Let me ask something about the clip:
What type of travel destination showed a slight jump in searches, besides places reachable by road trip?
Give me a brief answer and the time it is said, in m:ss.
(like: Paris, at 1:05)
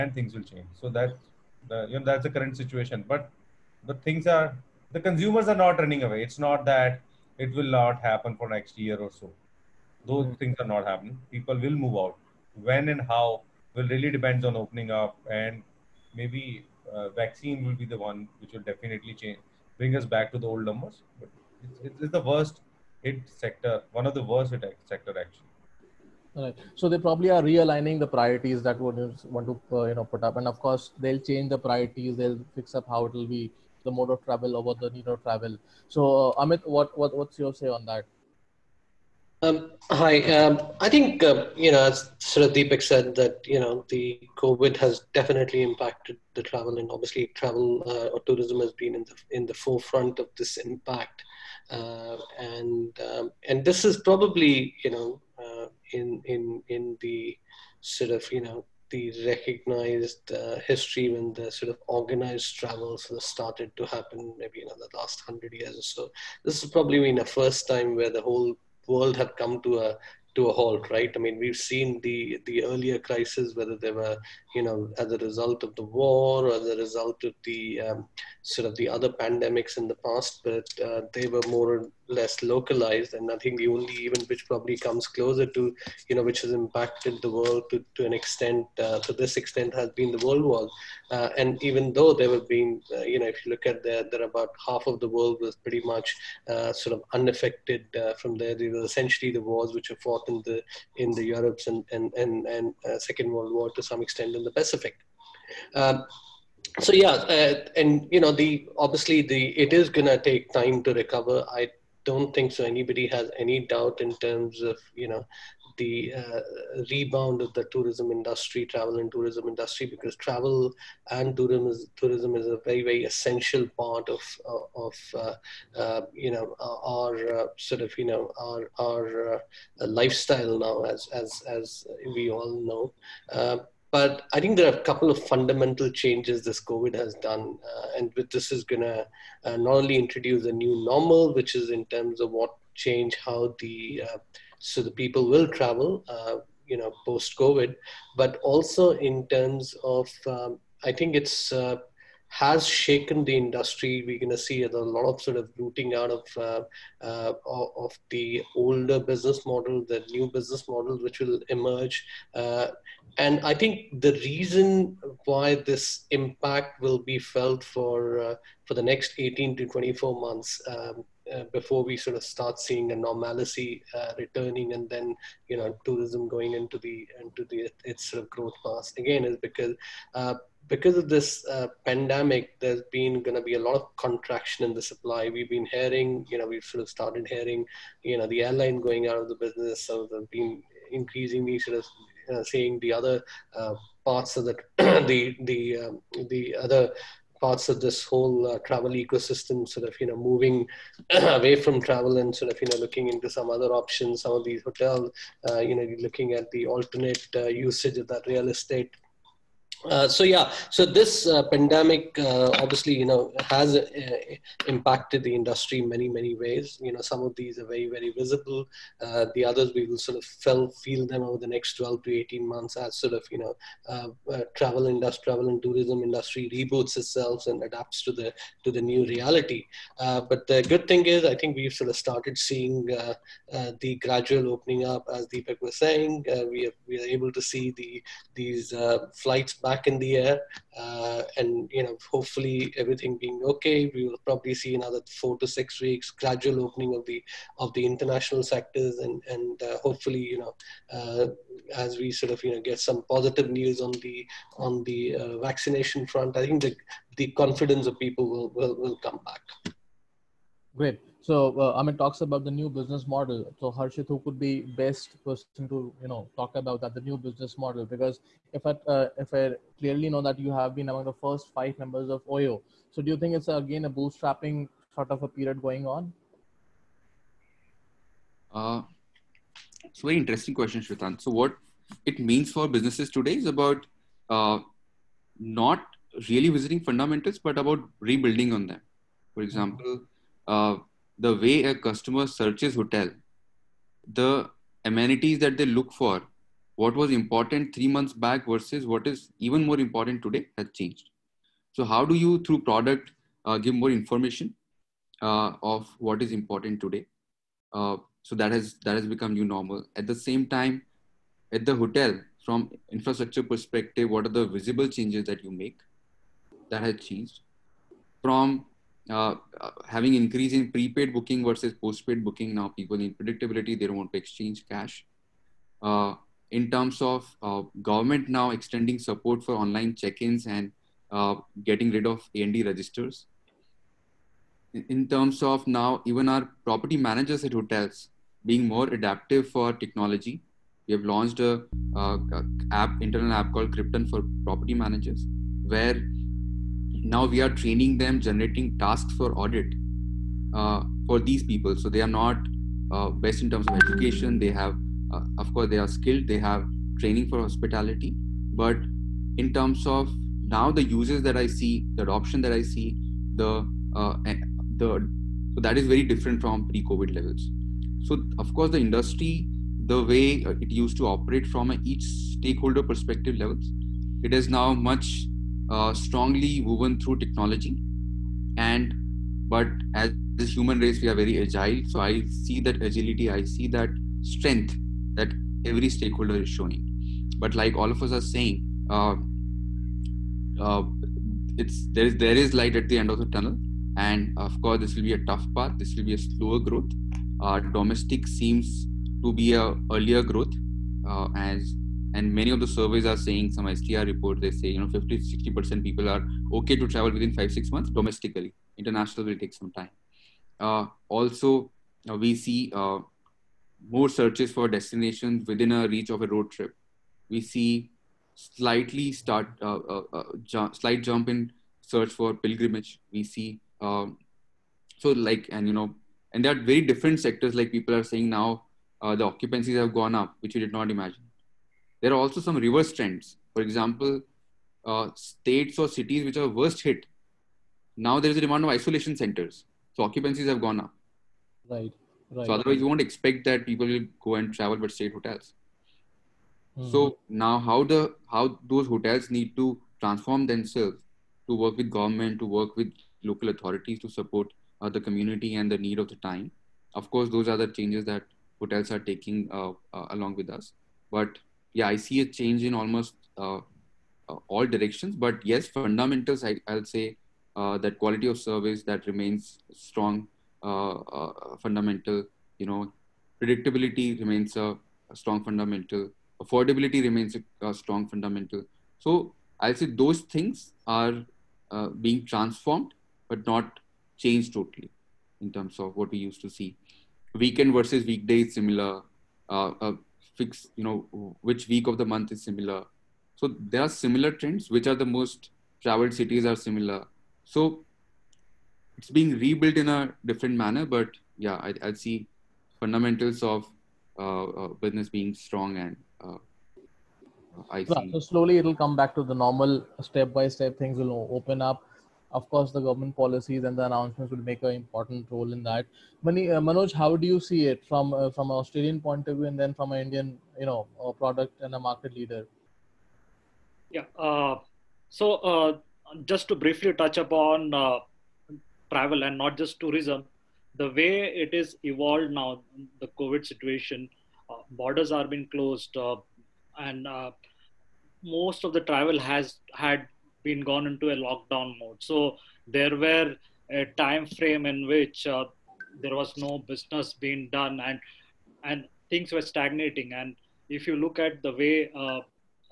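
Pilgrimage, at 7:02.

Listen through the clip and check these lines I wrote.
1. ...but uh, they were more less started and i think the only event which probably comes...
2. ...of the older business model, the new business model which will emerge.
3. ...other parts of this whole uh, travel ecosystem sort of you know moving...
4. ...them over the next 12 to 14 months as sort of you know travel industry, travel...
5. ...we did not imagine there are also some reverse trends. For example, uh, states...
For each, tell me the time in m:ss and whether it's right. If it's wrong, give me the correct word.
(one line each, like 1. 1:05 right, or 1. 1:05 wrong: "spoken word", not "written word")
1. 1:20 wrong: "localized", not "started"
2. 2:37 right
3. 3:16 right
4. 3:41 wrong: "18", not "14"
5. 7:10 right.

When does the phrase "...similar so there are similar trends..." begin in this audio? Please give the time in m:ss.
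8:12.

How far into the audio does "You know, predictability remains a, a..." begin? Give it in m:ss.
7:52.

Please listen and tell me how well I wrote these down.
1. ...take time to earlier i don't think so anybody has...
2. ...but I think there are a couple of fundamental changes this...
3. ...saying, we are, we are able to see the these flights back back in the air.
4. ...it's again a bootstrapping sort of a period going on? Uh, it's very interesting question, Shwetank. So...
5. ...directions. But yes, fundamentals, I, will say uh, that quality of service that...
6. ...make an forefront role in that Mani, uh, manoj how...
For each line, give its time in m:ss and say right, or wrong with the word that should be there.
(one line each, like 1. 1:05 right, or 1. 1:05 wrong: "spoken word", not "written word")
1. 1:50 wrong: "recover", not "earlier"
2. 2:13 right
3. 3:55 right
4. 4:33 right
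5. 7:44 right
6. 8:34 wrong: "important", not "forefront".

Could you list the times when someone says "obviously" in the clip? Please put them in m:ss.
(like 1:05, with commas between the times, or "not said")
0:46, 1:48, 3:32.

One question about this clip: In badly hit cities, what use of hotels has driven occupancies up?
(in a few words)
Isolation centers.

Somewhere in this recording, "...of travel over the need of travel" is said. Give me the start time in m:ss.
0:34.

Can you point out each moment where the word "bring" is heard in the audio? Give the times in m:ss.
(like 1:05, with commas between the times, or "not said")
0:19.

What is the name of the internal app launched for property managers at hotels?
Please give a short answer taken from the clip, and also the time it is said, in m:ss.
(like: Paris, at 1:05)
Krypton, at 5:43.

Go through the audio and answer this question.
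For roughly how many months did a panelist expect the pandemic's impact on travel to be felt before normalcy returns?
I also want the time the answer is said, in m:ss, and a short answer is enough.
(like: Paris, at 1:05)
18 to 24 months, at 2:49.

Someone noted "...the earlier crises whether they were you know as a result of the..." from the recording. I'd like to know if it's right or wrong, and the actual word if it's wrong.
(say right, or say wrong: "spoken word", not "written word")
right.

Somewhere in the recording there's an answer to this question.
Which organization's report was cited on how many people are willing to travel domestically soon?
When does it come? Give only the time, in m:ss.
6:43.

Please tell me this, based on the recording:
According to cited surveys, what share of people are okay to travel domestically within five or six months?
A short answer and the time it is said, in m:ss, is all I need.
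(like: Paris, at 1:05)
50-60%, at 6:44.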